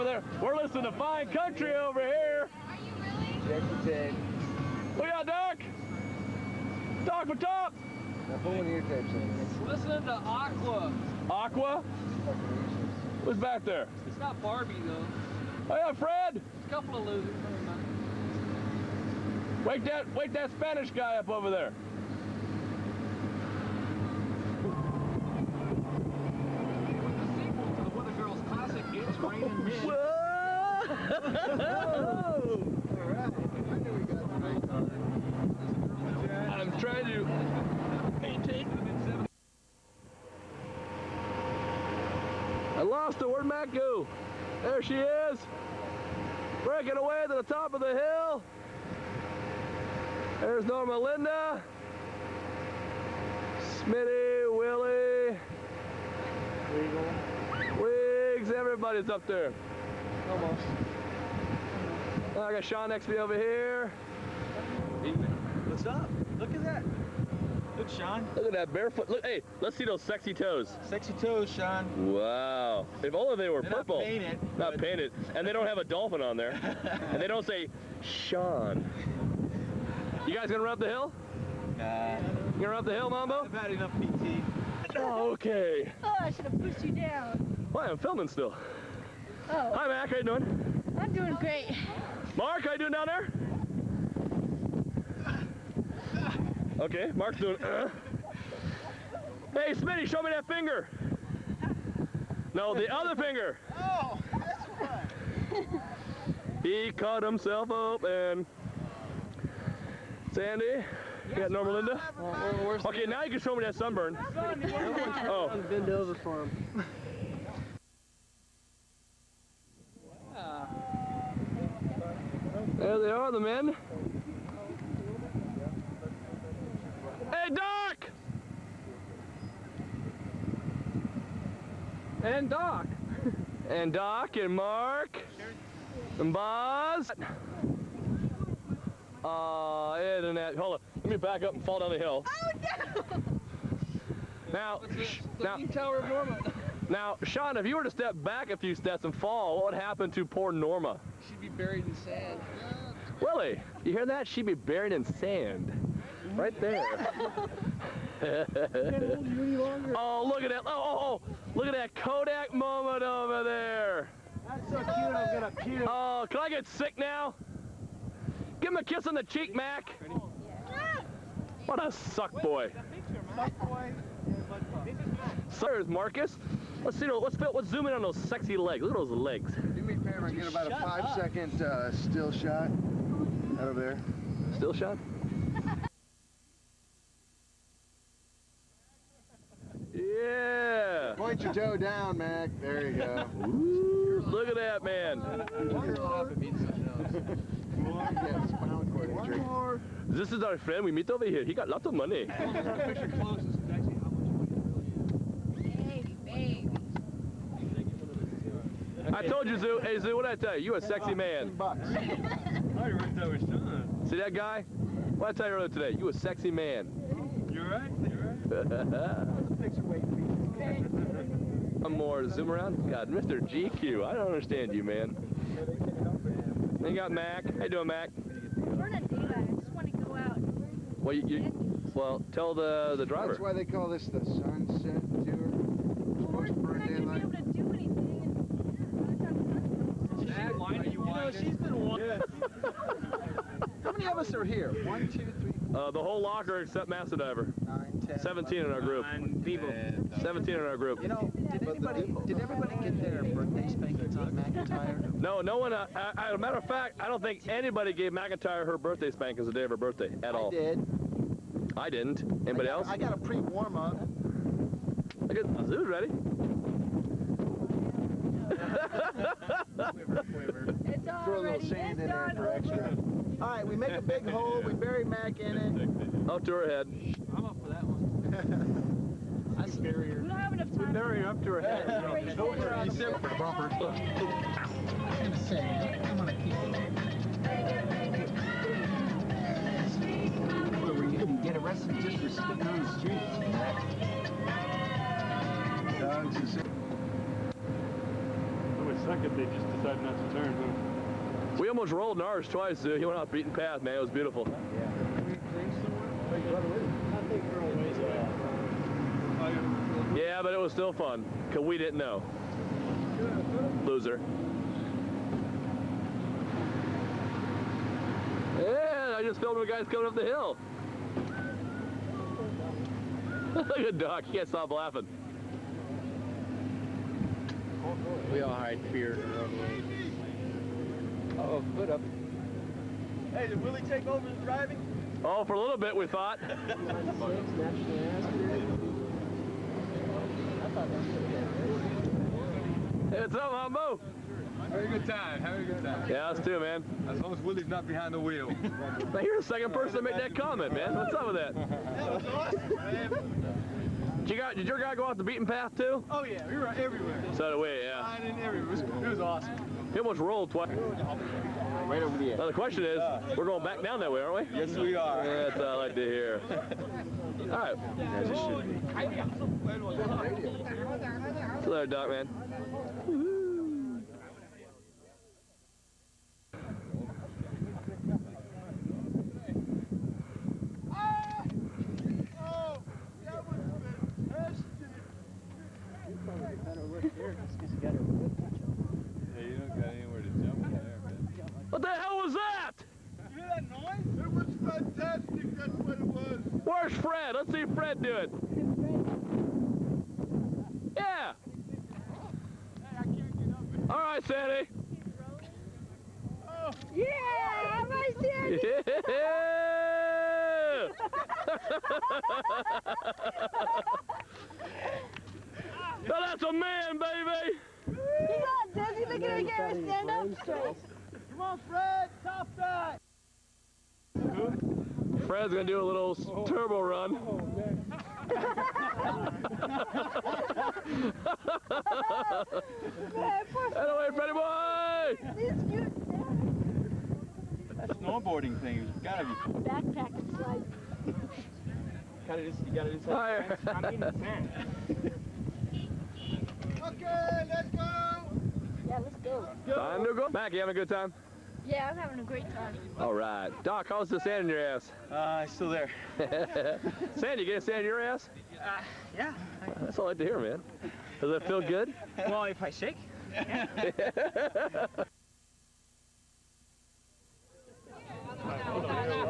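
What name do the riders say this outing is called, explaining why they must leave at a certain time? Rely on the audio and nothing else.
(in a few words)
the sunset tour.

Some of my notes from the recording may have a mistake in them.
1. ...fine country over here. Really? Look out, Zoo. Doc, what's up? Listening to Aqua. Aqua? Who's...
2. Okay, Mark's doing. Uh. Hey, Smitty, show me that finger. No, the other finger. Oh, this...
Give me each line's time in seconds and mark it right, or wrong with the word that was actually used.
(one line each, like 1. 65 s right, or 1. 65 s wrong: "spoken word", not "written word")
1. 0 s wrong: "Doc", not "Zoo"
2. 96 s right.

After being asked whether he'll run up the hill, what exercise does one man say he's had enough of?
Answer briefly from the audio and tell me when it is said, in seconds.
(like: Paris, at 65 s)
PT, at 83 s.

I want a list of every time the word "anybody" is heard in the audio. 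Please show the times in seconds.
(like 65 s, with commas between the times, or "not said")
251 s, 257 s, 262 s.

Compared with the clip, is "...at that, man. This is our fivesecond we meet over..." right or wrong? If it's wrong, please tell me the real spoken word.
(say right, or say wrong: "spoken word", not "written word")
wrong: "friend", not "fivesecond".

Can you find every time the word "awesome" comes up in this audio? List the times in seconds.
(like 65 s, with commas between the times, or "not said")
352 s, 359 s.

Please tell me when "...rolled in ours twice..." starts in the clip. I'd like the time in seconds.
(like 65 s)
301 s.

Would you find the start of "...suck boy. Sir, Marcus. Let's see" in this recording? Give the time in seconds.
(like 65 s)
171 s.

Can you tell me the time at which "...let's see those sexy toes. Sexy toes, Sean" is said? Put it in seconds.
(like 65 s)
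69 s.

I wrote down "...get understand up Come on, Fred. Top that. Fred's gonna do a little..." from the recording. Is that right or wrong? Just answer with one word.
wrong.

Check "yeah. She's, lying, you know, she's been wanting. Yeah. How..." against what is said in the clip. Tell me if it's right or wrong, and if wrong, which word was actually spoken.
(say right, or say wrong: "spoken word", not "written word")
right.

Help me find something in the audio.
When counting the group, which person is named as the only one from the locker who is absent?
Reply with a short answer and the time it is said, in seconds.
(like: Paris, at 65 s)
Master Diver, at 246 s.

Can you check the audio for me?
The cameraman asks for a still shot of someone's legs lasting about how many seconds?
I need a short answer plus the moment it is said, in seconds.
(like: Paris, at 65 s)
5, at 180 s.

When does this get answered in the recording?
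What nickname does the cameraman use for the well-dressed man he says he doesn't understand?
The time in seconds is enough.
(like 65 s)
223 s.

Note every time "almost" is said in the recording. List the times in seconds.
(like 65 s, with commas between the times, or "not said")
60 s, 301 s, 359 s.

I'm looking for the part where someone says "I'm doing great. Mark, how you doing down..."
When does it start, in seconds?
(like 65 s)
90 s.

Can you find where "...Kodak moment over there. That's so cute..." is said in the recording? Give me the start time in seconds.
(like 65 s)
161 s.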